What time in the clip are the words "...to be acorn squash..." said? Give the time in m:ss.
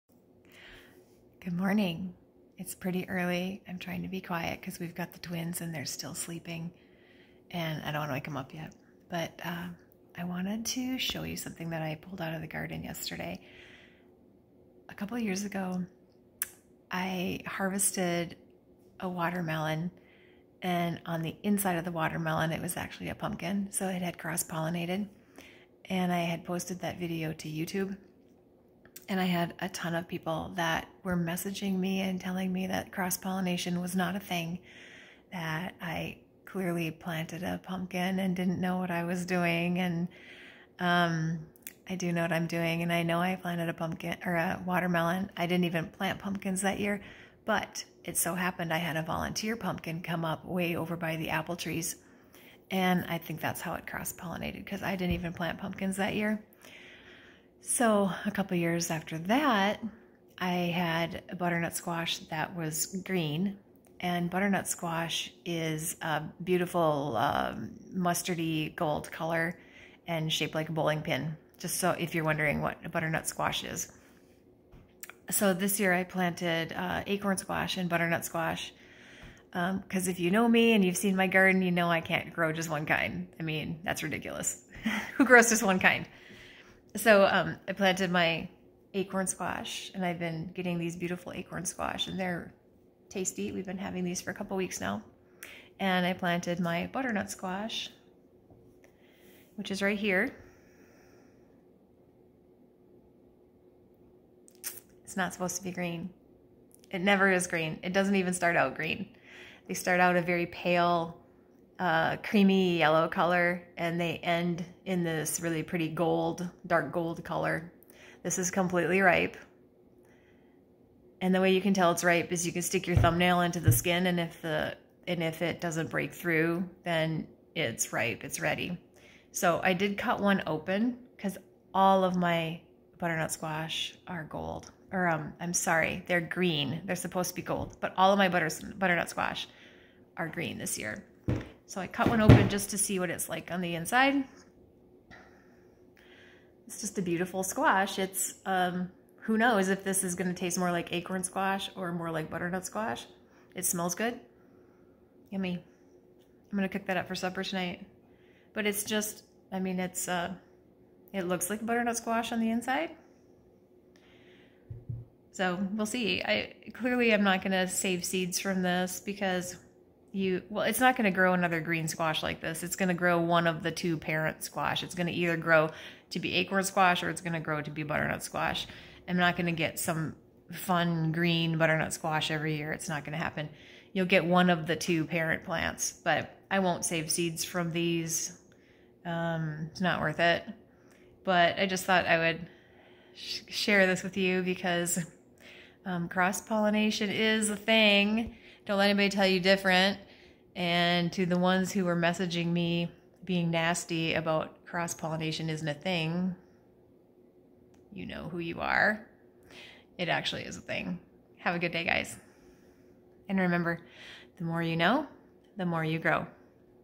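2:56.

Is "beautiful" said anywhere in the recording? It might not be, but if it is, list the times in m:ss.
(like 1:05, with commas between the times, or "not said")
1:06, 1:30, 2:27.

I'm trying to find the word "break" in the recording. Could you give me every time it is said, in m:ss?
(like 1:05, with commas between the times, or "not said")
2:05.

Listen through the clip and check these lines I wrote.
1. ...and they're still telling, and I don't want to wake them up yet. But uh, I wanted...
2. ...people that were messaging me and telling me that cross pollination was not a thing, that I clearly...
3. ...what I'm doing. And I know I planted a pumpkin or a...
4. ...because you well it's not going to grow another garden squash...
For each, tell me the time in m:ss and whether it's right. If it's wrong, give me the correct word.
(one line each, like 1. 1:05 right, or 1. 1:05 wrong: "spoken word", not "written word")
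1. 0:05 wrong: "sleeping", not "telling"
2. 0:30 right
3. 0:42 right
4. 2:48 wrong: "green", not "garden".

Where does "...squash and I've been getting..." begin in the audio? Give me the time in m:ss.
1:29.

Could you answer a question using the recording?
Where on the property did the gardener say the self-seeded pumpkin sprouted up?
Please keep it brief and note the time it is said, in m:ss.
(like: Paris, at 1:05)
by the apple trees, at 0:50.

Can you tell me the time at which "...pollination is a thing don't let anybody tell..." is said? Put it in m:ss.
3:16.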